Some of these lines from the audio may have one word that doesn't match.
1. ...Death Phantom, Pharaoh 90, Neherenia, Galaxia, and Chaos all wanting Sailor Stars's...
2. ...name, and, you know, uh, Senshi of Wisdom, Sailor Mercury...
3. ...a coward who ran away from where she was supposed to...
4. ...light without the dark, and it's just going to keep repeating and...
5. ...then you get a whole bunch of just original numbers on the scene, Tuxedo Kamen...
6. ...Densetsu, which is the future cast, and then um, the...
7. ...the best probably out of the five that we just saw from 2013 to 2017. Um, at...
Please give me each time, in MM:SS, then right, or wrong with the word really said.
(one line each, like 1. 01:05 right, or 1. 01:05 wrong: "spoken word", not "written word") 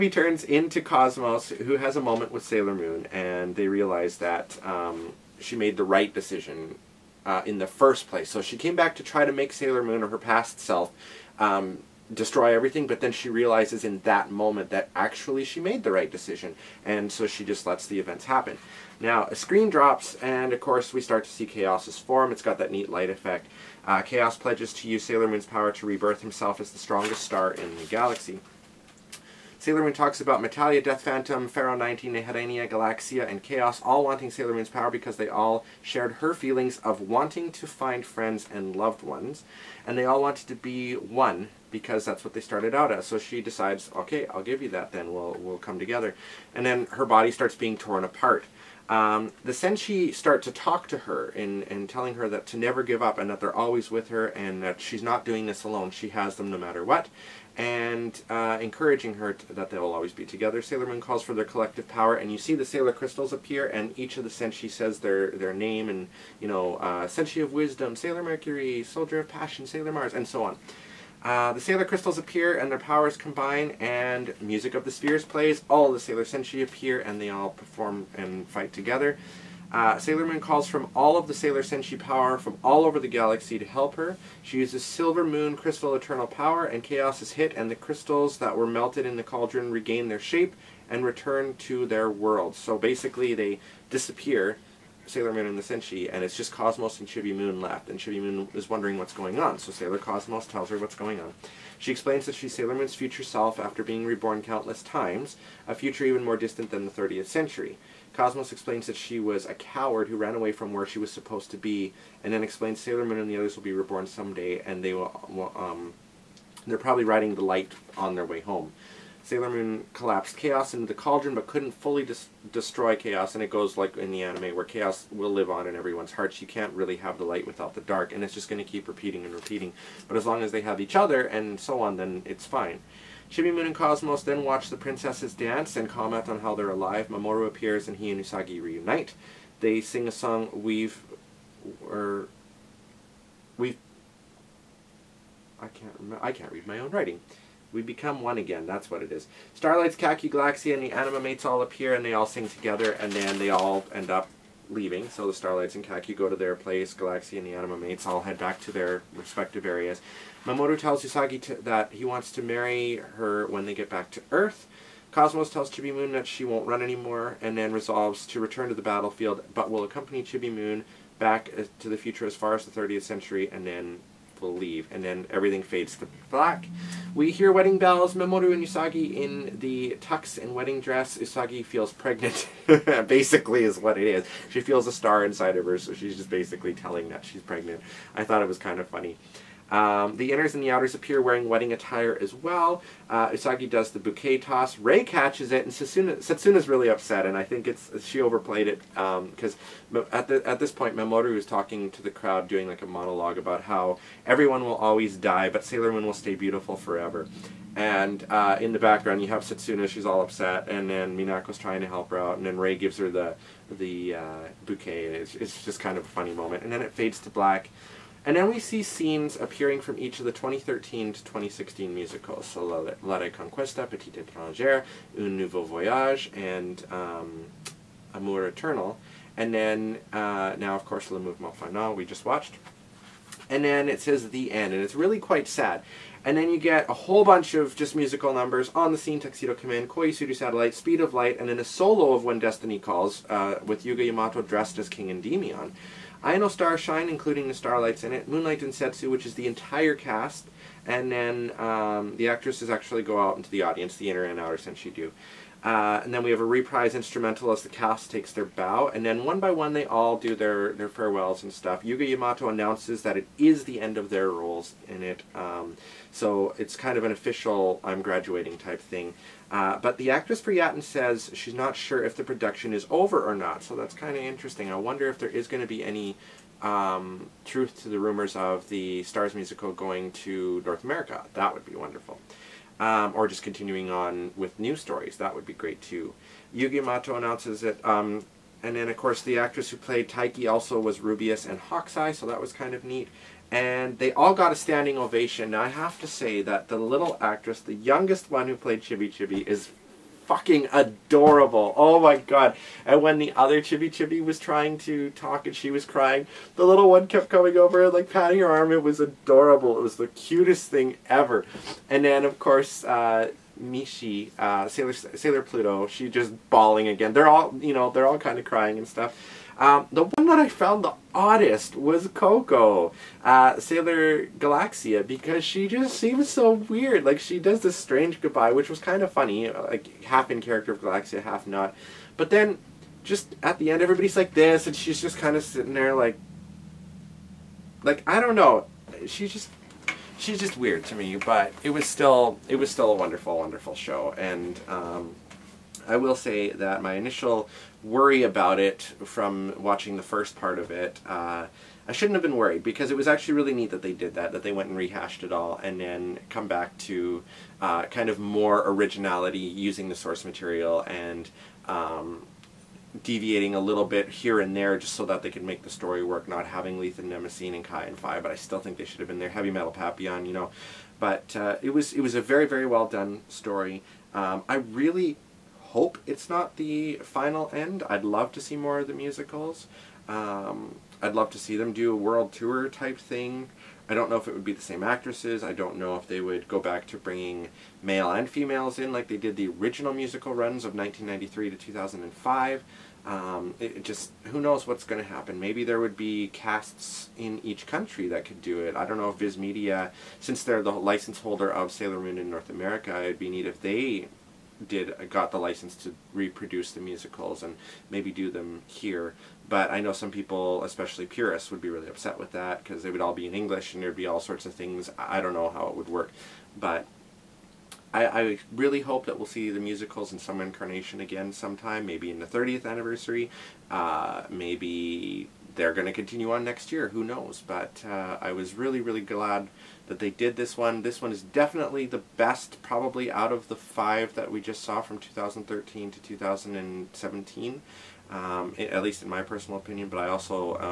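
1. 00:30 wrong: "Moon", not "Stars"
2. 01:05 right
3. 01:49 right
4. 02:07 right
5. 03:56 wrong: "musical", not "original"
6. 04:08 wrong: "entire", not "future"
7. 07:11 right.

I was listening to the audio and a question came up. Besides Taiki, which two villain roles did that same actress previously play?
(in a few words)
Rubeus and Hawkeye.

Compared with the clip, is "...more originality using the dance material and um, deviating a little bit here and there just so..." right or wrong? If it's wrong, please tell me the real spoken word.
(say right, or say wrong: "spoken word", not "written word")
wrong: "source", not "dance".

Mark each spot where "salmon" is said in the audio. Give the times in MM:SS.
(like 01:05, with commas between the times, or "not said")
not said.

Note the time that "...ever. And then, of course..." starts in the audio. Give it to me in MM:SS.
05:11.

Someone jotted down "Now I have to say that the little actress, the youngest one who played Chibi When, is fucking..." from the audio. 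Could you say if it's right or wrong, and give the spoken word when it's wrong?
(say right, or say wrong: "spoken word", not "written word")
wrong: "Chibi", not "When".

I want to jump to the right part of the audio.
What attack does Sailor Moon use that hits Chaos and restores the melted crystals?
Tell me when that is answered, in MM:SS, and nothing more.
01:24.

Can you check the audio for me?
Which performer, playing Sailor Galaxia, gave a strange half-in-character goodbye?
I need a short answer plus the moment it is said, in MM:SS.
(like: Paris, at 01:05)
Coco, at 05:22.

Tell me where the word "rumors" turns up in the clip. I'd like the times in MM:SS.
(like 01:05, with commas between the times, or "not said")
04:37.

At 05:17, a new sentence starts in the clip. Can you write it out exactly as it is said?
They're all, you know, they're all kind of crying and stuff.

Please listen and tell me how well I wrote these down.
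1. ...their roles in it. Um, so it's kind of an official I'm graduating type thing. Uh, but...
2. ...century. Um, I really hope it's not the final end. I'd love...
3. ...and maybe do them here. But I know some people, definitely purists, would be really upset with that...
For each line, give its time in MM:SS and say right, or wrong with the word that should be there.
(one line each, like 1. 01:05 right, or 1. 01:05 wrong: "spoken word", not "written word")
1. 04:24 right
2. 06:13 wrong: "story", not "century"
3. 06:47 wrong: "especially", not "definitely".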